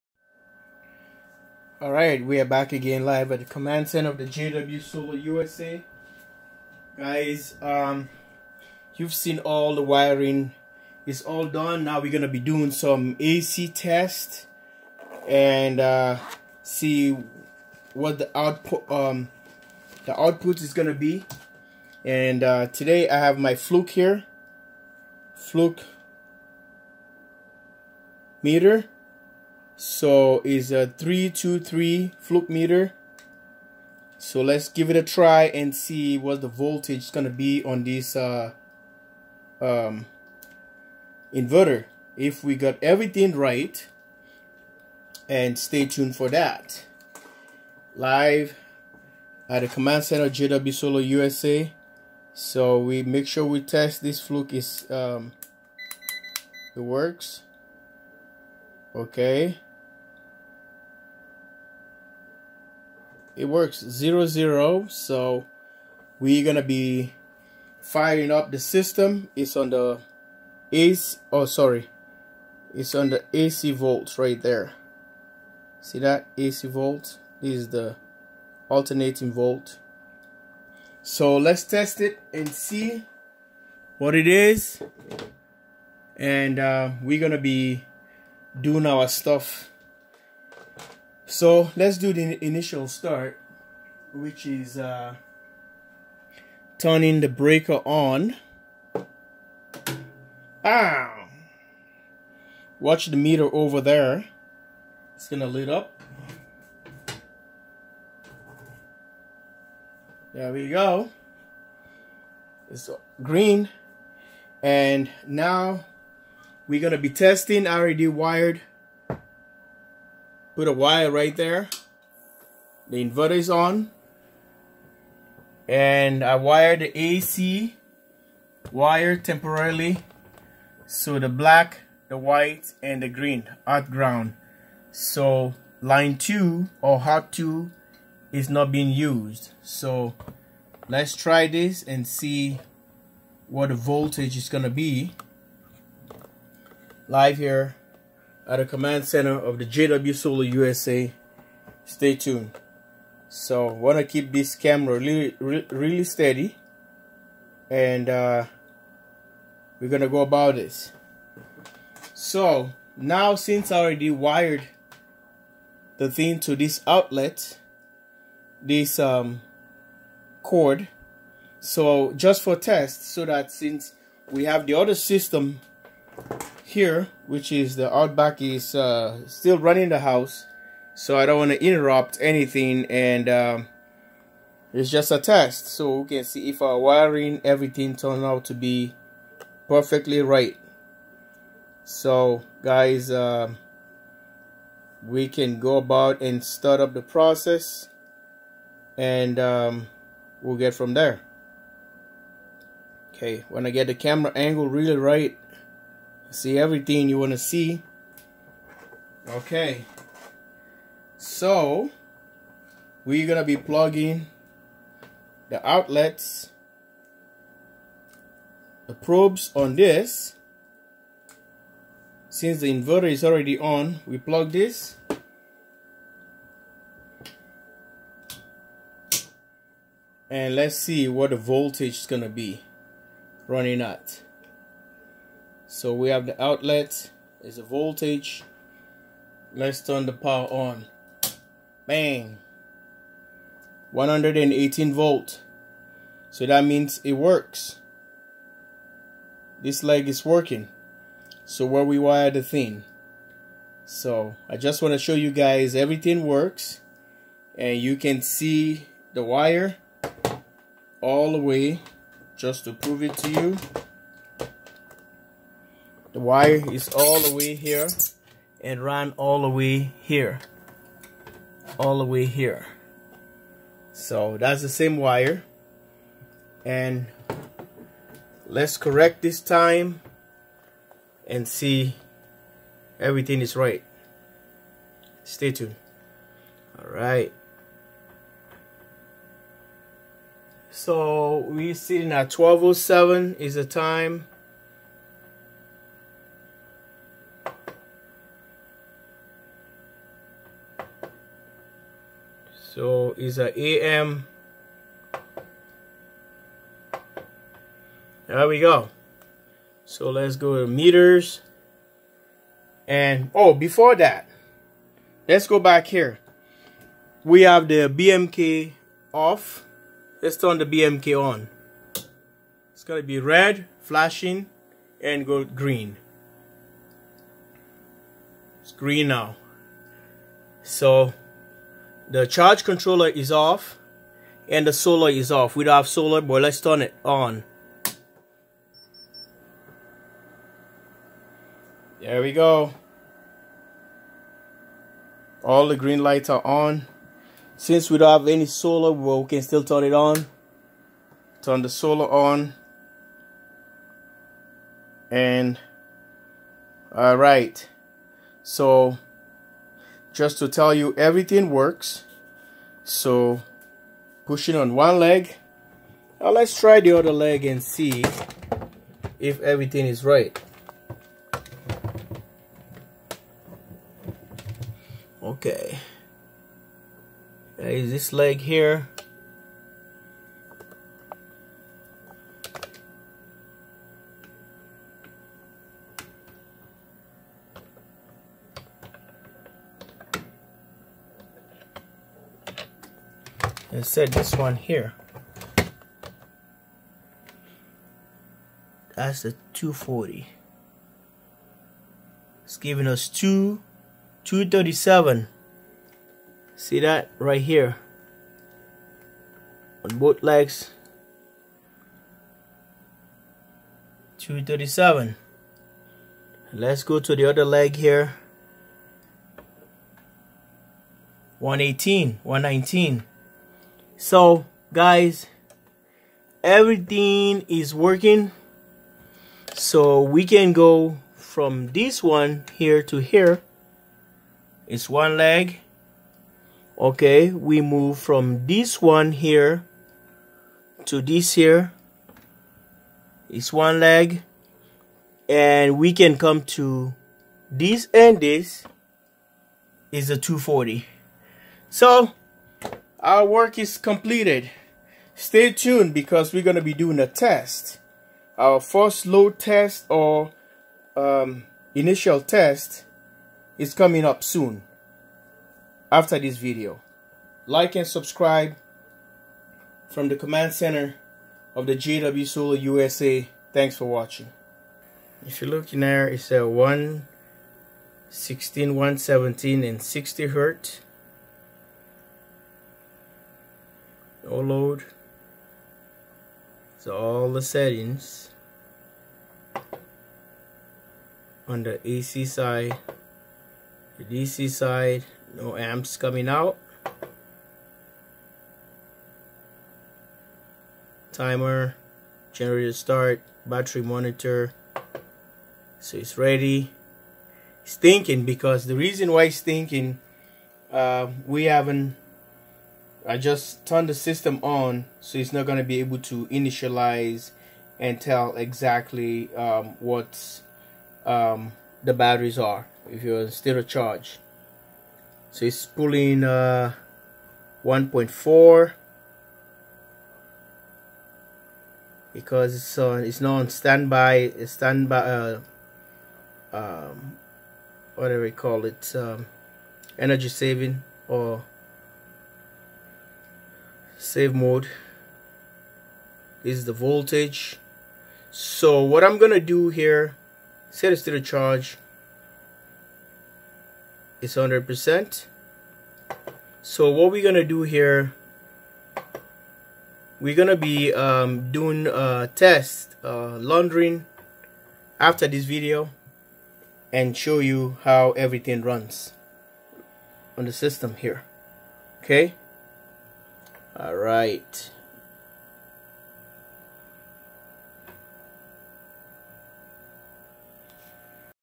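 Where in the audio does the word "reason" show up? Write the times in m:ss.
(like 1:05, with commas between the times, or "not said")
8:28.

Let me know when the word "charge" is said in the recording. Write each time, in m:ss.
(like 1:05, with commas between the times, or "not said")
5:32, 8:43, 9:11.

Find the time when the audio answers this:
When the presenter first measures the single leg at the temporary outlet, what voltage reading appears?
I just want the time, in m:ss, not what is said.
4:03.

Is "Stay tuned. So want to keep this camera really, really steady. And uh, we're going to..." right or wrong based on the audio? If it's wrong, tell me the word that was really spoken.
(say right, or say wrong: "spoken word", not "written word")
right.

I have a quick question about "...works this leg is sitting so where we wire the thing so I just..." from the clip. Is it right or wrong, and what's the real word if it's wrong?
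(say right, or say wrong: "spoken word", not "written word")
wrong: "working", not "sitting".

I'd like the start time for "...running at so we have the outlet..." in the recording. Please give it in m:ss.
3:53.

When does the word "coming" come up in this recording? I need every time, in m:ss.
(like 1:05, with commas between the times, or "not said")
7:43, 8:15.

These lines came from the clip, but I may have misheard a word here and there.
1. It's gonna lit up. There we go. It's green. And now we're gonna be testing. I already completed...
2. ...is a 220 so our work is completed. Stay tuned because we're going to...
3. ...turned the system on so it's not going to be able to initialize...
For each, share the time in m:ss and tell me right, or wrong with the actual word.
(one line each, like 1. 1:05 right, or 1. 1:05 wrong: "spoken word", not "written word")
1. 1:45 wrong: "wired", not "completed"
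2. 7:29 wrong: "240", not "220"
3. 8:33 right.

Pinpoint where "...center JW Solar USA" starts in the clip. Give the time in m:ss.
0:50.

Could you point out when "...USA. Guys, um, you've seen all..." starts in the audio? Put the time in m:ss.
0:05.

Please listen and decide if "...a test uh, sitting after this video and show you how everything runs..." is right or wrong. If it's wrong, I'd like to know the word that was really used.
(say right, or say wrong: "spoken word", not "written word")
wrong: "laundering", not "sitting".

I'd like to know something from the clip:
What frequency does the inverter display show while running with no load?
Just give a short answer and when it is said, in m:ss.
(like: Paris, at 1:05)
60 hertz, at 7:59.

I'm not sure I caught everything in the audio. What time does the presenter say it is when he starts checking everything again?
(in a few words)
12:07 AM.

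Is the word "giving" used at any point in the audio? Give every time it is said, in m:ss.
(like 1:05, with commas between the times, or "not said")
6:42.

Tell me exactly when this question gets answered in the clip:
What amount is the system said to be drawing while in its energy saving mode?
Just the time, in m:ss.
8:47.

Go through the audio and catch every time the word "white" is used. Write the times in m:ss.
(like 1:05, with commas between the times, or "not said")
2:12.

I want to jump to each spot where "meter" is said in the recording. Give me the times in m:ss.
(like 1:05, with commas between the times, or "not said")
0:28, 0:32, 1:43, 5:10.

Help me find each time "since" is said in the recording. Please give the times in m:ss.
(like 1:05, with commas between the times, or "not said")
2:43, 2:53, 3:42, 5:47.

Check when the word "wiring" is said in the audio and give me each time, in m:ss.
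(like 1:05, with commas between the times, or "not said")
0:09, 3:06.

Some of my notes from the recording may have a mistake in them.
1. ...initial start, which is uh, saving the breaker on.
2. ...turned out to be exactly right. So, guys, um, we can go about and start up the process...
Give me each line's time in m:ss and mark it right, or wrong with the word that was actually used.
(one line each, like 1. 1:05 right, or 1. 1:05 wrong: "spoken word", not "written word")
1. 1:32 wrong: "turning", not "saving"
2. 3:07 wrong: "perfectly", not "exactly".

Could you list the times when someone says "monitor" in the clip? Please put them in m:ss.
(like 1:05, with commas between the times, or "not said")
8:23.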